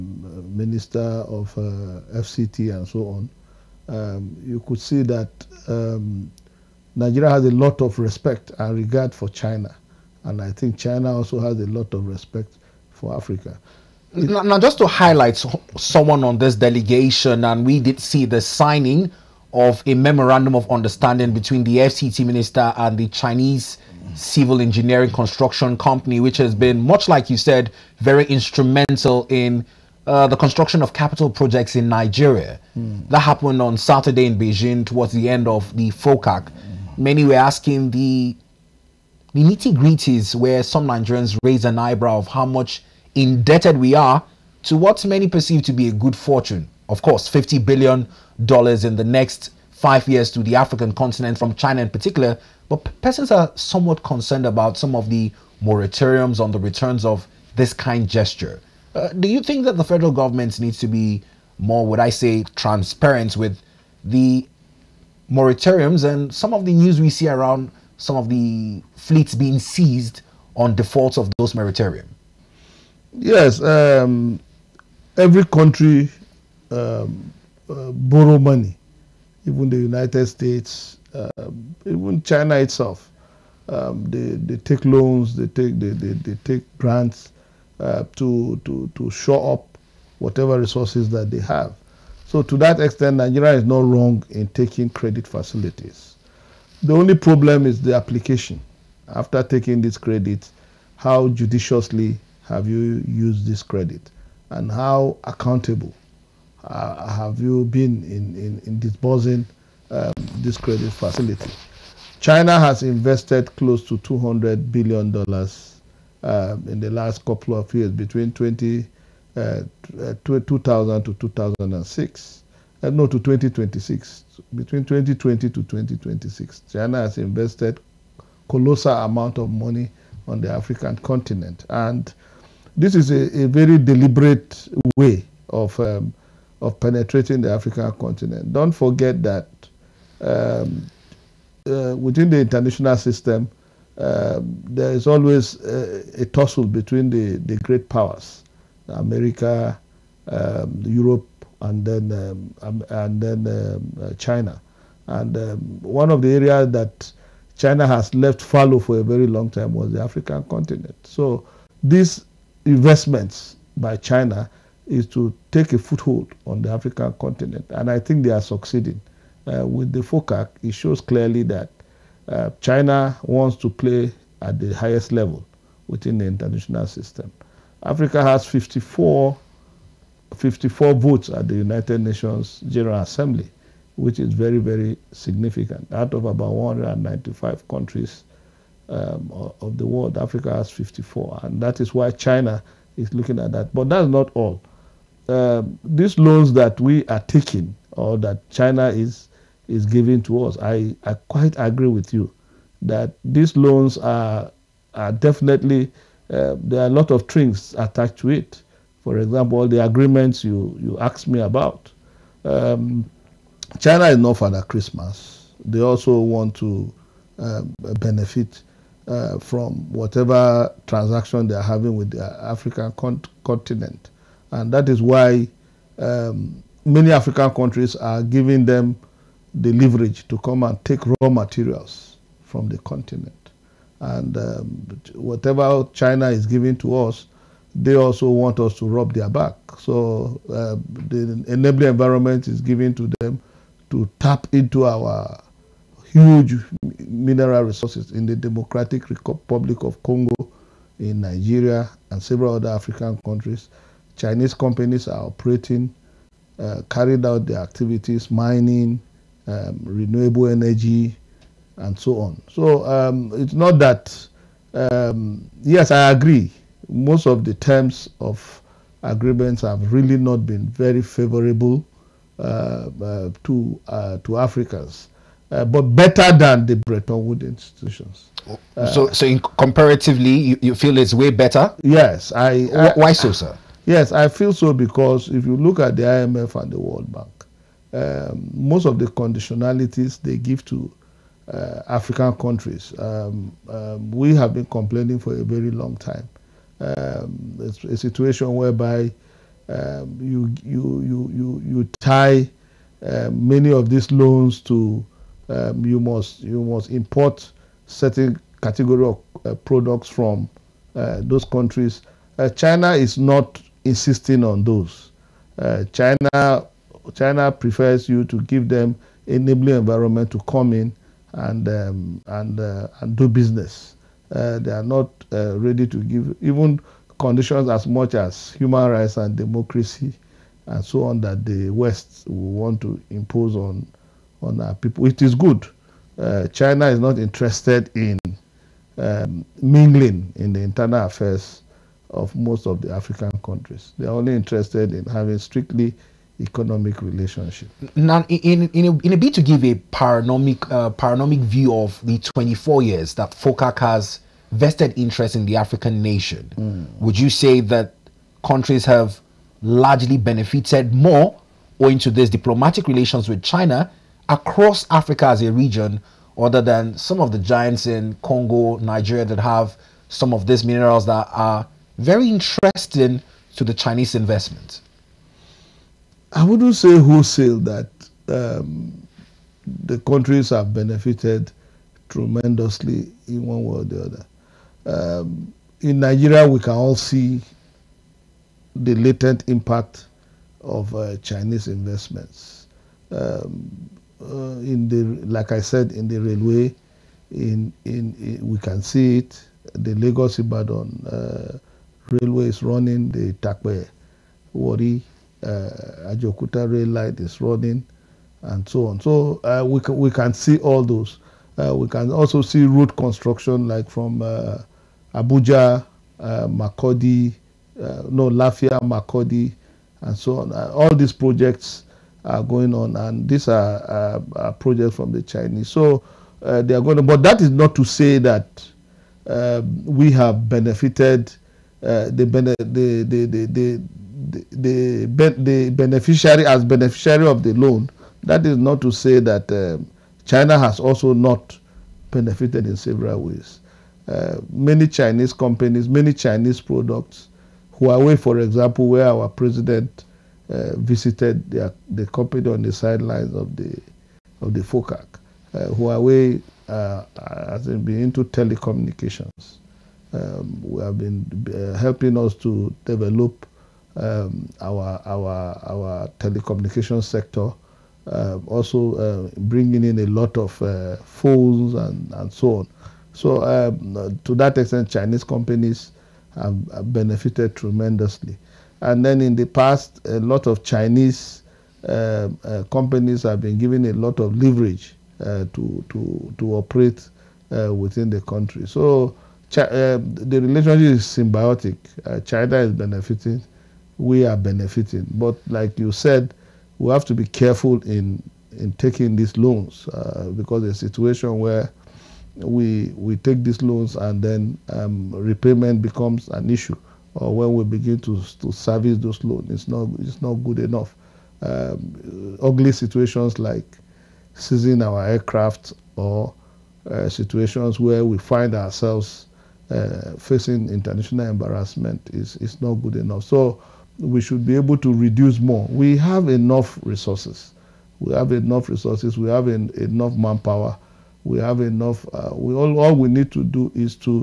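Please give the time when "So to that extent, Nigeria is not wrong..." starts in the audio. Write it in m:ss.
1:32.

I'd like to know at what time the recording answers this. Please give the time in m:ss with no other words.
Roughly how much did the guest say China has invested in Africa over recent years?
1:53.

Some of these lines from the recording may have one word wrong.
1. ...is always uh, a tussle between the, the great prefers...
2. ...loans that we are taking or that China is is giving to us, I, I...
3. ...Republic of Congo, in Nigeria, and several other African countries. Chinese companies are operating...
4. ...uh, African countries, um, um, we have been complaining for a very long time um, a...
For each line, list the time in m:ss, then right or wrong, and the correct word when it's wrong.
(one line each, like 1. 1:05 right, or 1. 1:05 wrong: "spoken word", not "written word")
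1. 2:24 wrong: "powers", not "prefers"
2. 3:16 right
3. 4:09 right
4. 4:51 right.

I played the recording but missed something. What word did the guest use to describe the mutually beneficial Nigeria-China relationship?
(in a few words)
symbiotic.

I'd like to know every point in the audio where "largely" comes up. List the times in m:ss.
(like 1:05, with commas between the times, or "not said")
5:59.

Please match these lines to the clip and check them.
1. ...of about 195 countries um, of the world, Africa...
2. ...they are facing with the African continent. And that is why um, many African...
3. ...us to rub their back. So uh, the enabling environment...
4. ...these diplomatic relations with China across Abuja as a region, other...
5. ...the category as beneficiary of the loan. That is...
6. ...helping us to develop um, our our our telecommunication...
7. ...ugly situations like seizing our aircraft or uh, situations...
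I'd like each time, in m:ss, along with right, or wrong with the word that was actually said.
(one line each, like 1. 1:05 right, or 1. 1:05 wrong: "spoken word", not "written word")
1. 3:06 right
2. 3:41 wrong: "having", not "facing"
3. 3:58 right
4. 6:02 wrong: "Africa", not "Abuja"
5. 7:15 wrong: "beneficiary", not "category"
6. 7:41 right
7. 8:32 right.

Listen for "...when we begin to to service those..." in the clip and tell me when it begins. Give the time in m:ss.
8:27.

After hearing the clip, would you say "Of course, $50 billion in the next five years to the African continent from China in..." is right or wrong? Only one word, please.
right.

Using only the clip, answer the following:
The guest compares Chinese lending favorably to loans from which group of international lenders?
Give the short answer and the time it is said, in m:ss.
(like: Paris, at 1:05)
Bretton Woods institutions, at 4:36.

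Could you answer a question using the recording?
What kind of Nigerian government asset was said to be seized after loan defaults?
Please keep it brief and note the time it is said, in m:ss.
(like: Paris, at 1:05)
fleets, at 1:08.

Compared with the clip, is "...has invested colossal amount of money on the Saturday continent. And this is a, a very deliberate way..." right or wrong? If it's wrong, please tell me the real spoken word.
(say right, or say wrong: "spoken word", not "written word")
wrong: "African", not "Saturday".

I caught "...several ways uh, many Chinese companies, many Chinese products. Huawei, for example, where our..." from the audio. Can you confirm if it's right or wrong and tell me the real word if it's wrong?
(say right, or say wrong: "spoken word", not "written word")
right.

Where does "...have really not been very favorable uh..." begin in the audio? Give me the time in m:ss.
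4:29.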